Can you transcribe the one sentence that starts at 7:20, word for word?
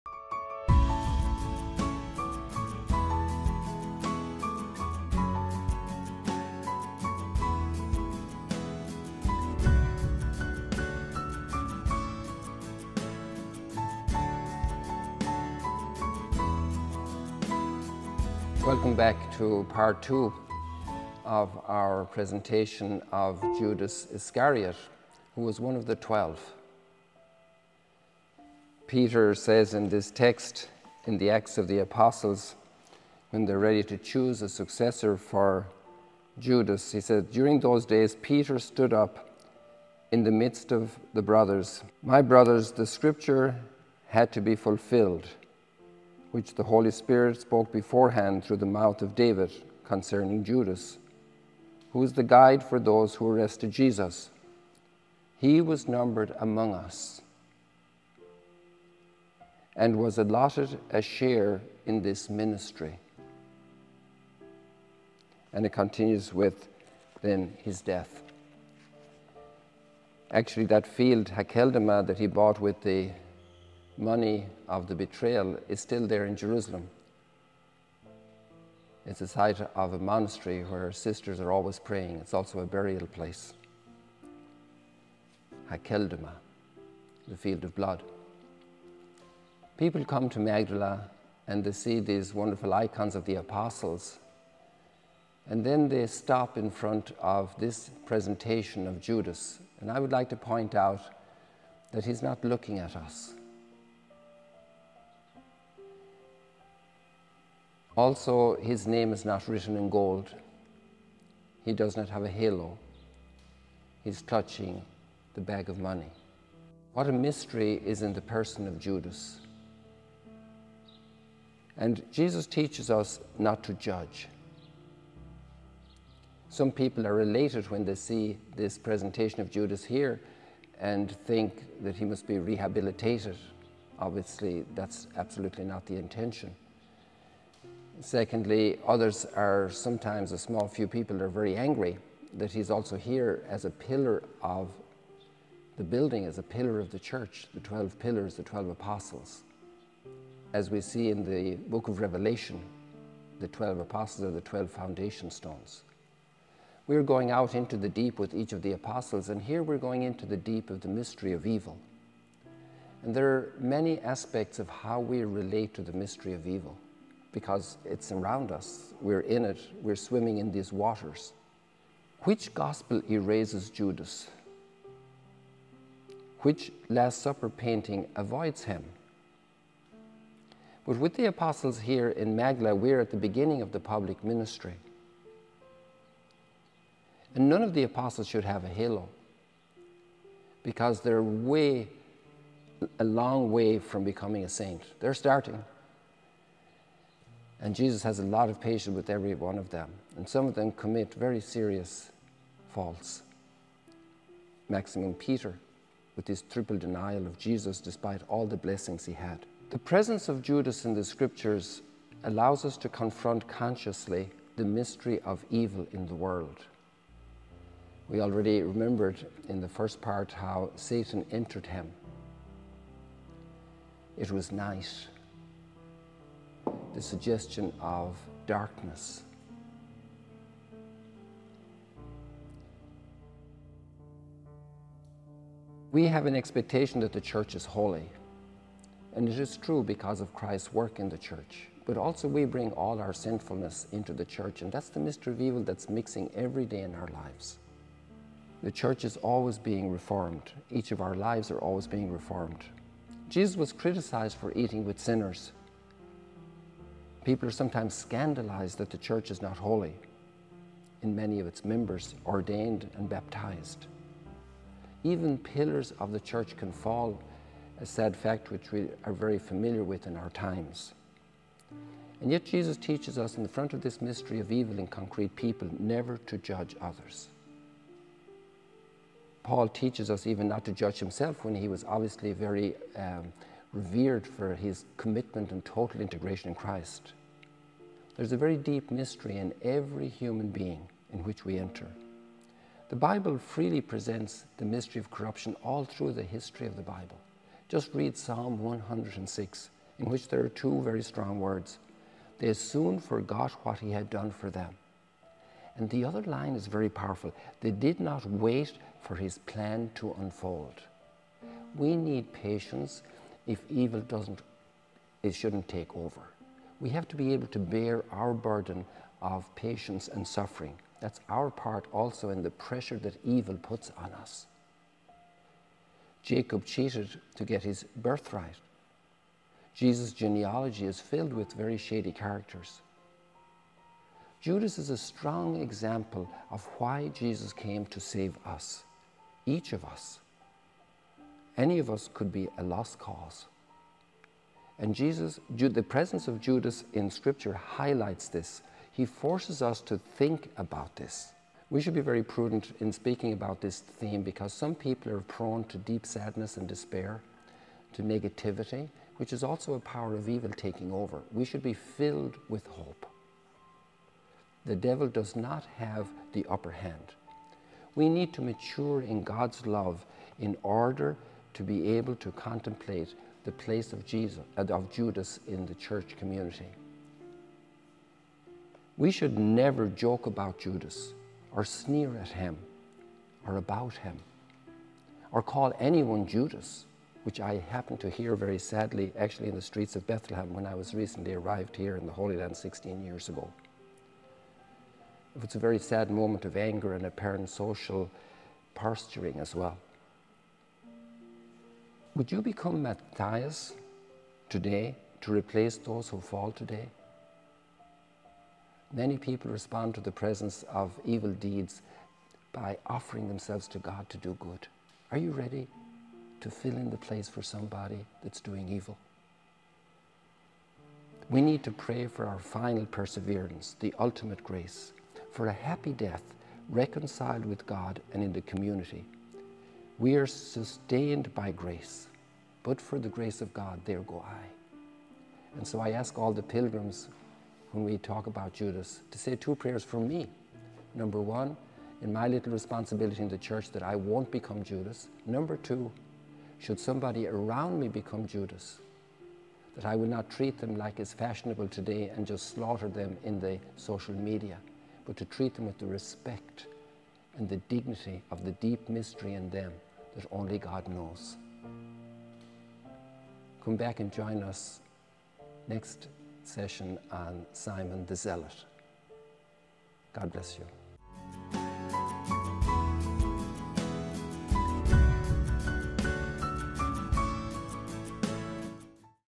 Number one, in my little responsibility in the church, that I won't become Judas.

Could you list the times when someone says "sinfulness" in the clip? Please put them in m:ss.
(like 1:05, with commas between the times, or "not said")
4:03.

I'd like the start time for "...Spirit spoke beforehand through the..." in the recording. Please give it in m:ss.
0:46.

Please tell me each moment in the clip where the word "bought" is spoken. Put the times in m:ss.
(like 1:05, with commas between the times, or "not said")
1:12.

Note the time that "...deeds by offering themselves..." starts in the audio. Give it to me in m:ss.
6:51.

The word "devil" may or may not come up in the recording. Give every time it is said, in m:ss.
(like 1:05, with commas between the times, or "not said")
6:04.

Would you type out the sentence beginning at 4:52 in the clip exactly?
The Bible freely presents the mystery of corruption all through the history of the Bible.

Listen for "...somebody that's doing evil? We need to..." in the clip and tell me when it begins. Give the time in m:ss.
6:57.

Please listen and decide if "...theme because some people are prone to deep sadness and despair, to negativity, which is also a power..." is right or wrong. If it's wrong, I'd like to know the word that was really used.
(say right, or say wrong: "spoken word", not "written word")
right.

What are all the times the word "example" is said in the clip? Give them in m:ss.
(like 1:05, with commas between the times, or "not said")
5:35.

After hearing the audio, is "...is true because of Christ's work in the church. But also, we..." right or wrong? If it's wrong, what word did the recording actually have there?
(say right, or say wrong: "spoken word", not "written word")
right.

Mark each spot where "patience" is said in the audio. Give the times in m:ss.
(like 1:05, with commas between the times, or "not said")
3:18, 5:12, 5:19.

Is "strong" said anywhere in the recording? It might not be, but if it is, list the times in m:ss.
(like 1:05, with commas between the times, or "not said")
5:01, 5:34.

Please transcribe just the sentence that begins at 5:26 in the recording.
Jacob cheated to get his birthright.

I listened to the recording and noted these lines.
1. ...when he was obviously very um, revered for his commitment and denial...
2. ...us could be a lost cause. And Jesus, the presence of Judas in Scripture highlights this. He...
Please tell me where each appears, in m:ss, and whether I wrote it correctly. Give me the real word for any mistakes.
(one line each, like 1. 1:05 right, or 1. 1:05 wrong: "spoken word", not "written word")
1. 4:41 wrong: "total", not "denial"
2. 5:41 right.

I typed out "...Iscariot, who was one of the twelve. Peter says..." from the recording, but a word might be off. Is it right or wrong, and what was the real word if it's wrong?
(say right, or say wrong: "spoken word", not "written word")
right.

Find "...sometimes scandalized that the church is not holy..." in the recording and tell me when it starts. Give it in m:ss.
4:17.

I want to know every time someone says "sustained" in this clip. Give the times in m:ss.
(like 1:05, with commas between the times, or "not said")
7:10.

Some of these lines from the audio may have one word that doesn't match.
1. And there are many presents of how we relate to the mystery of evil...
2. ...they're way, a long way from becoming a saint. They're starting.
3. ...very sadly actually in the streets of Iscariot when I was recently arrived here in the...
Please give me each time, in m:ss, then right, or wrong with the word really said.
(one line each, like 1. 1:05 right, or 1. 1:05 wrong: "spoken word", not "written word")
1. 2:43 wrong: "aspects", not "presents"
2. 3:10 right
3. 6:28 wrong: "Bethlehem", not "Iscariot".